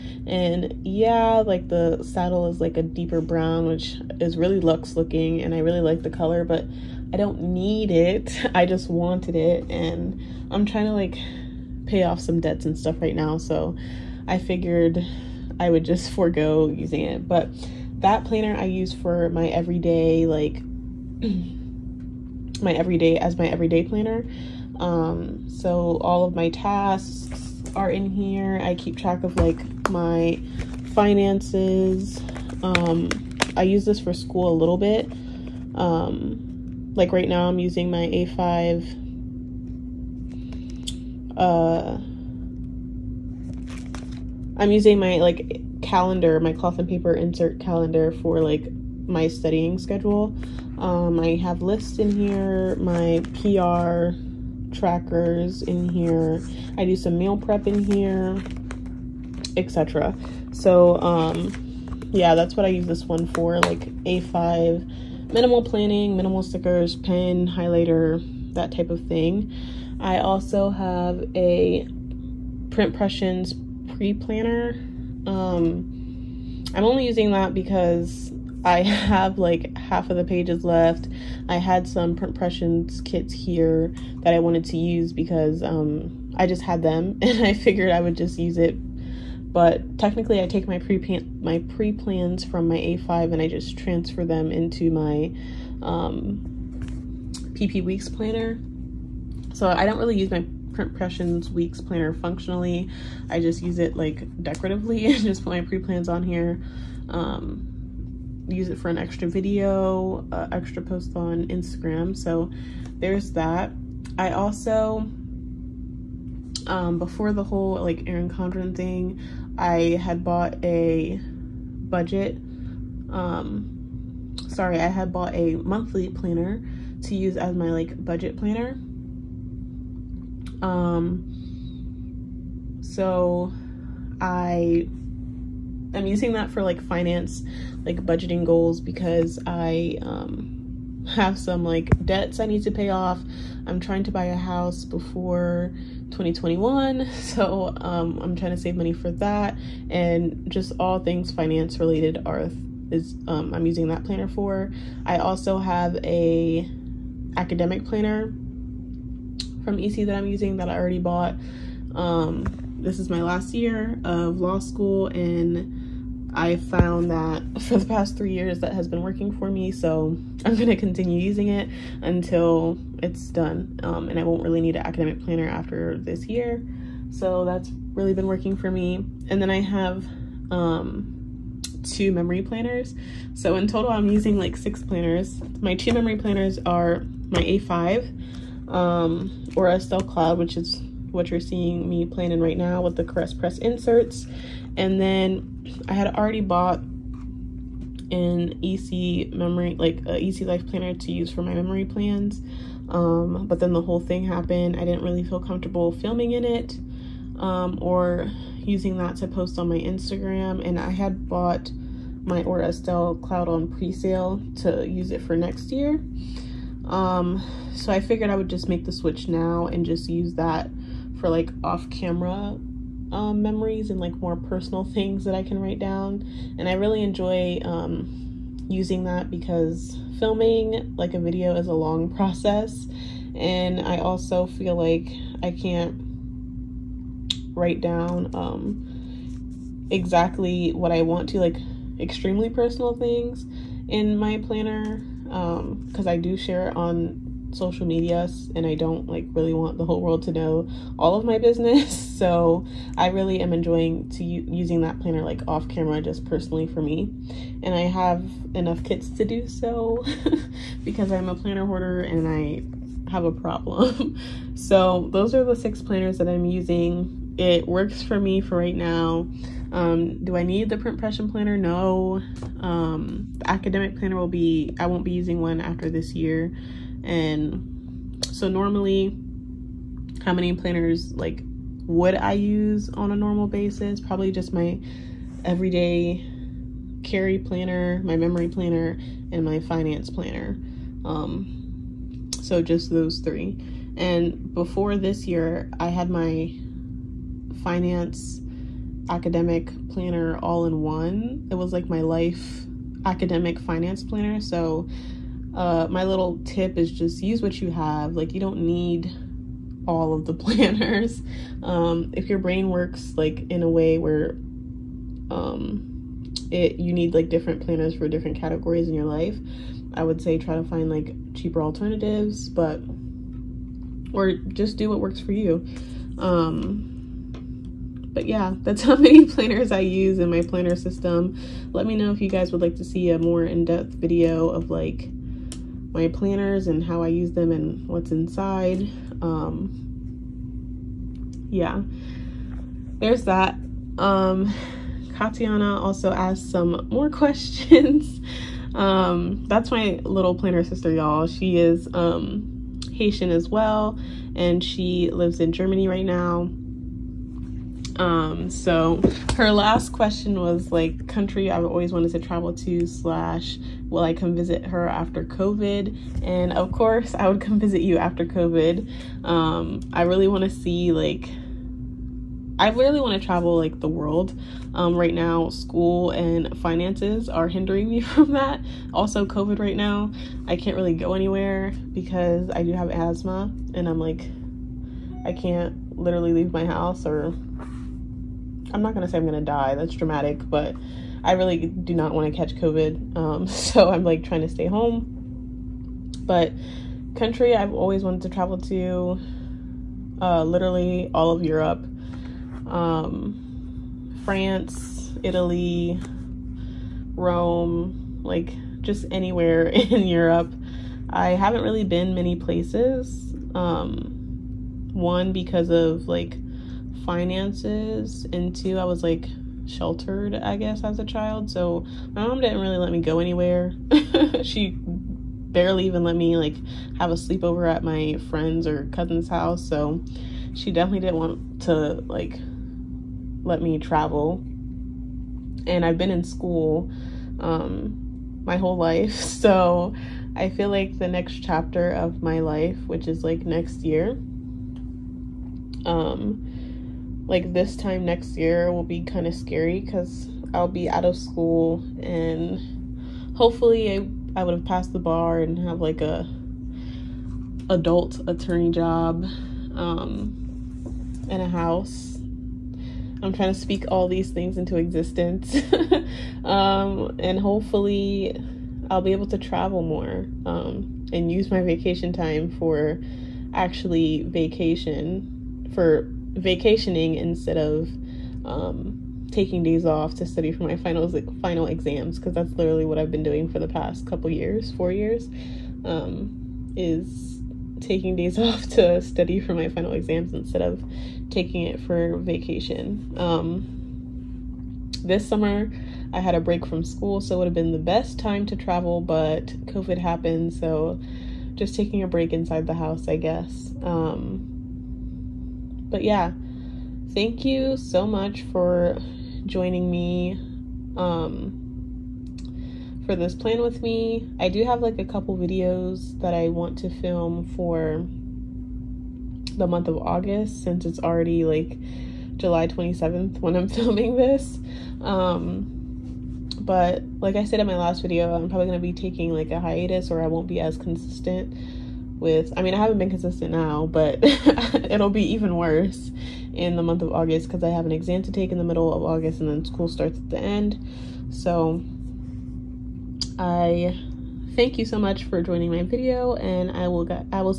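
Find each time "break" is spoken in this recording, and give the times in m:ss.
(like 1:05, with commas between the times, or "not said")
8:16, 8:22.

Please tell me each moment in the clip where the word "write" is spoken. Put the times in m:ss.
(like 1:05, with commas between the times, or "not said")
3:45, 3:57.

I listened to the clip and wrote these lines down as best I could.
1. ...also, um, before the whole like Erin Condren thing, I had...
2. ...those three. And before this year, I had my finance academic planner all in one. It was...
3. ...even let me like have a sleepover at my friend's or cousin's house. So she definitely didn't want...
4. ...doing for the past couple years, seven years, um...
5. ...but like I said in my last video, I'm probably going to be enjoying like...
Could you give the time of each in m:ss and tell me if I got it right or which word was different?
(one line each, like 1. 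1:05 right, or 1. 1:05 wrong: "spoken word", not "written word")
1. 1:54 right
2. 4:52 right
3. 7:05 right
4. 8:03 wrong: "four", not "seven"
5. 8:46 wrong: "taking", not "enjoying".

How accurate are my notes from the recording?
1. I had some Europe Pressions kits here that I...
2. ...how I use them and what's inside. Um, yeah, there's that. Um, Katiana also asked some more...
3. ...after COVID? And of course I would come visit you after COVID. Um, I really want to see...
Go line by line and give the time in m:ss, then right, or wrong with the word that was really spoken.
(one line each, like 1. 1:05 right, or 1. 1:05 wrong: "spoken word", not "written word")
1. 1:21 wrong: "Print", not "Europe"
2. 5:36 right
3. 6:04 right.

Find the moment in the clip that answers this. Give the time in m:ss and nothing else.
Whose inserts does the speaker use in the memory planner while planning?
3:13.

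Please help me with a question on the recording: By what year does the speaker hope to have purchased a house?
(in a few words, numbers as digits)
2021.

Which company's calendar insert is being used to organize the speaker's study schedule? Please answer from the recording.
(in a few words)
Cloth and Paper.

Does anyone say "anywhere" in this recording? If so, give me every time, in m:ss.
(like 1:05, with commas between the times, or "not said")
6:21, 6:49, 7:03.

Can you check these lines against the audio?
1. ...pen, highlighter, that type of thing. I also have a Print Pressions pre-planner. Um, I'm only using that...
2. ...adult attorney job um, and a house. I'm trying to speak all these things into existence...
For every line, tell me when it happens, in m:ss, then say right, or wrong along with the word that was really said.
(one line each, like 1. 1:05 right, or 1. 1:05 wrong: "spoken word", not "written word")
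1. 1:06 right
2. 7:37 right.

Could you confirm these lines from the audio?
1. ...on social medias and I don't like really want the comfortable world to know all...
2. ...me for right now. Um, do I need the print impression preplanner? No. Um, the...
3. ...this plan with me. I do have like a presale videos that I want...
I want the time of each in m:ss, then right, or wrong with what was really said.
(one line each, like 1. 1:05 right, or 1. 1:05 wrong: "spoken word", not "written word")
1. 4:06 wrong: "whole", not "comfortable"
2. 4:28 wrong: "planner", not "preplanner"
3. 8:33 wrong: "couple", not "presale".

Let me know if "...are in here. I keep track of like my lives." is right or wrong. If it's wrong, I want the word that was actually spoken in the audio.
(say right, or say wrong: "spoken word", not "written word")
wrong: "finances", not "lives".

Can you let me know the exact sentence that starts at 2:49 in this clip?
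So I'm going to continue using it until it's done.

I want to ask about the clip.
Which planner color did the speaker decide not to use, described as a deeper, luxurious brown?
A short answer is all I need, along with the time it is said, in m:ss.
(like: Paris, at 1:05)
Saddle, at 0:02.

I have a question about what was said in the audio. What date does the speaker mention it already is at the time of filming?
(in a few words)
July 27th.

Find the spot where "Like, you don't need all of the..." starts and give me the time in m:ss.
5:08.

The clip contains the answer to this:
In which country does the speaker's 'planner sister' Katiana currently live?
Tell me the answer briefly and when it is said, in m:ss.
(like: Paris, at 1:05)
Germany, at 5:55.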